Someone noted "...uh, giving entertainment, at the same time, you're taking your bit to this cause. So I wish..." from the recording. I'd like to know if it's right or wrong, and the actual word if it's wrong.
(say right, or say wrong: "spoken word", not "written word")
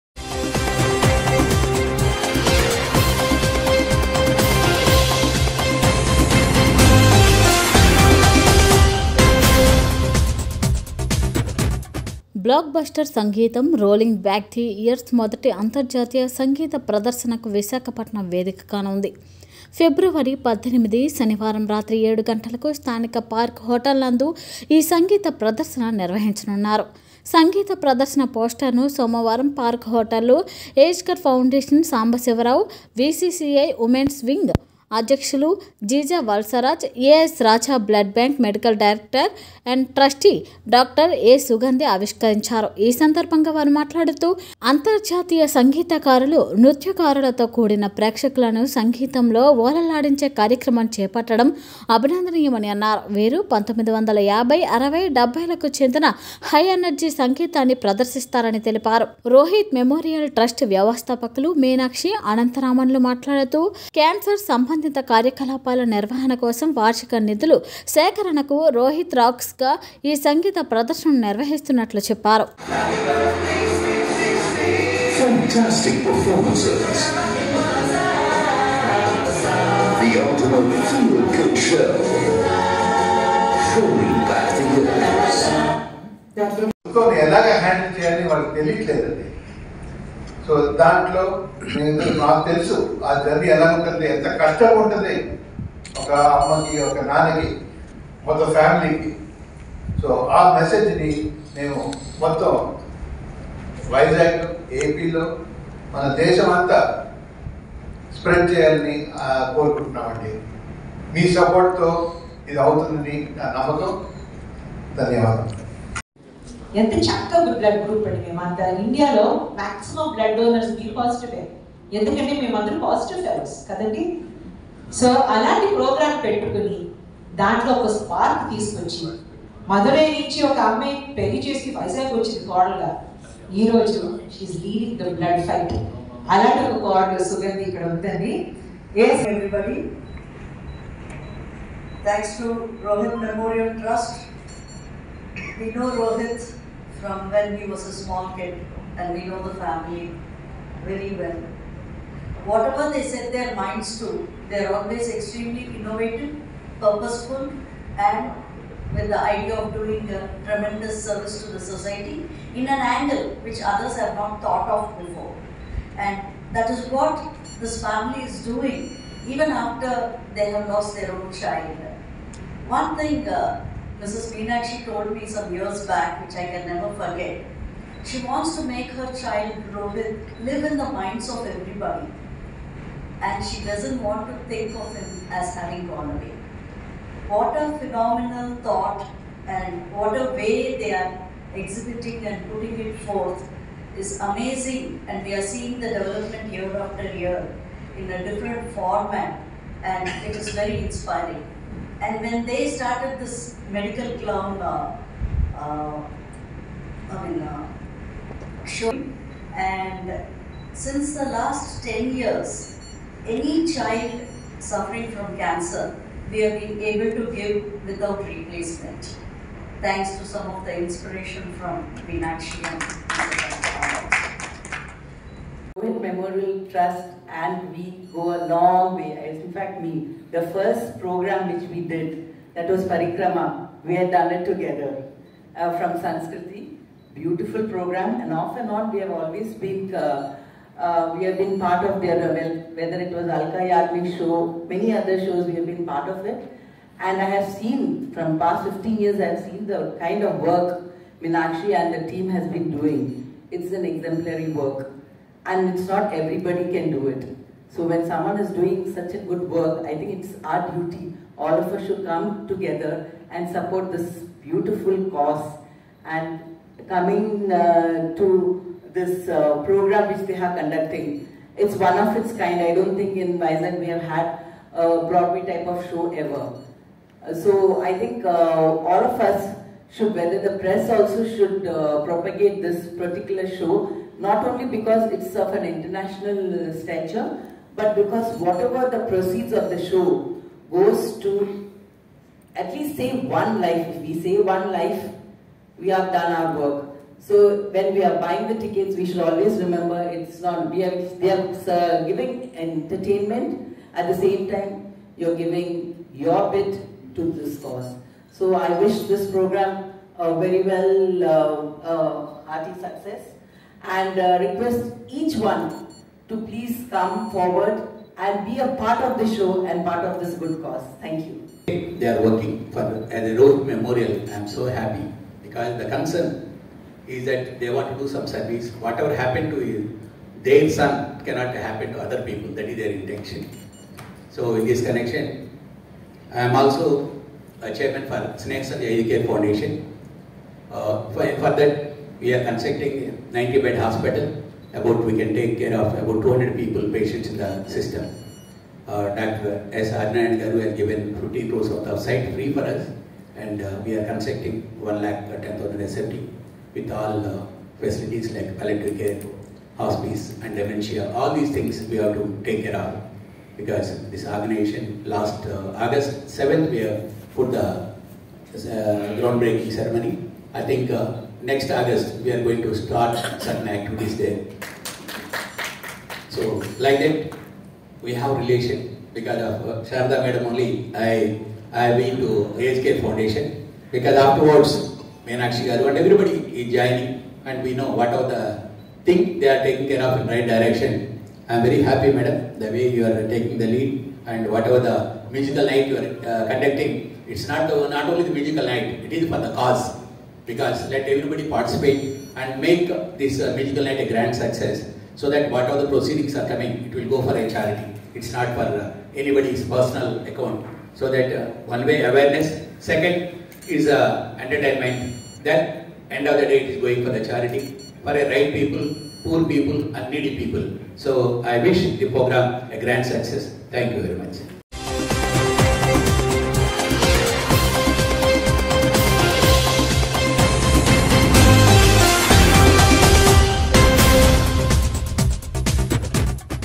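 wrong: "giving", not "taking".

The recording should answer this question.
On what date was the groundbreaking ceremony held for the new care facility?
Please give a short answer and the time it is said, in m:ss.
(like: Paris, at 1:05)
August 7, at 6:05.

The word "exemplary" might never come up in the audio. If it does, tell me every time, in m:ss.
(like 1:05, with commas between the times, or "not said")
4:13.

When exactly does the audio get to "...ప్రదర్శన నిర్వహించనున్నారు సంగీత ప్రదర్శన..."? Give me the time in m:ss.
0:25.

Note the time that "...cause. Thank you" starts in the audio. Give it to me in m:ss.
5:20.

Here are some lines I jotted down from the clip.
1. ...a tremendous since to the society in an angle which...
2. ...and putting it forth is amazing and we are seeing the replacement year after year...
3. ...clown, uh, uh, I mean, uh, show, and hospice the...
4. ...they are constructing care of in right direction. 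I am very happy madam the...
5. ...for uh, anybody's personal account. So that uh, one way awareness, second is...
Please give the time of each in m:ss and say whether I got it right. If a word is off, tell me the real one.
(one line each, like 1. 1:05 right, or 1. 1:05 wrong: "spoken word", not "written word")
1. 2:40 wrong: "service", not "since"
2. 3:12 wrong: "development", not "replacement"
3. 3:24 wrong: "since", not "hospice"
4. 6:29 wrong: "taking", not "constructing"
5. 6:48 right.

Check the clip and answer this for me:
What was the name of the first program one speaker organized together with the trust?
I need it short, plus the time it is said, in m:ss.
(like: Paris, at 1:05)
Parikrama, at 3:52.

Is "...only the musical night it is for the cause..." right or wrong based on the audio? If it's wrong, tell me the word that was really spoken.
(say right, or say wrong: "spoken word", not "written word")
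right.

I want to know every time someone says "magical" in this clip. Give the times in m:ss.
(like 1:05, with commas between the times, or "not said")
6:43.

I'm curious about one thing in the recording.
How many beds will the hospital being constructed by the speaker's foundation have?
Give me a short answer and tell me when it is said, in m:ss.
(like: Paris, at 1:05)
90, at 5:43.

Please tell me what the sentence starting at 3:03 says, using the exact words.
And she doesn't want to think of him as having gone away.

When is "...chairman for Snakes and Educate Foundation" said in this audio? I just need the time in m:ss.
5:37.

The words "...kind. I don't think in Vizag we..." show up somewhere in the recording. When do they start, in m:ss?
4:32.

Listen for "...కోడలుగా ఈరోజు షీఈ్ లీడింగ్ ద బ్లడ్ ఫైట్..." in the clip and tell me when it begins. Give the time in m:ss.
2:12.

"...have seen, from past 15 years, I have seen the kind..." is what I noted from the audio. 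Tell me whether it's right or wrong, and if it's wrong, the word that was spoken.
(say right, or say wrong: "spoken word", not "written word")
right.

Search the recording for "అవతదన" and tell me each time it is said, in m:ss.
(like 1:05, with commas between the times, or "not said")
1:52.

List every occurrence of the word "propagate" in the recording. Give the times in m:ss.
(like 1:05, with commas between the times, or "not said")
4:42.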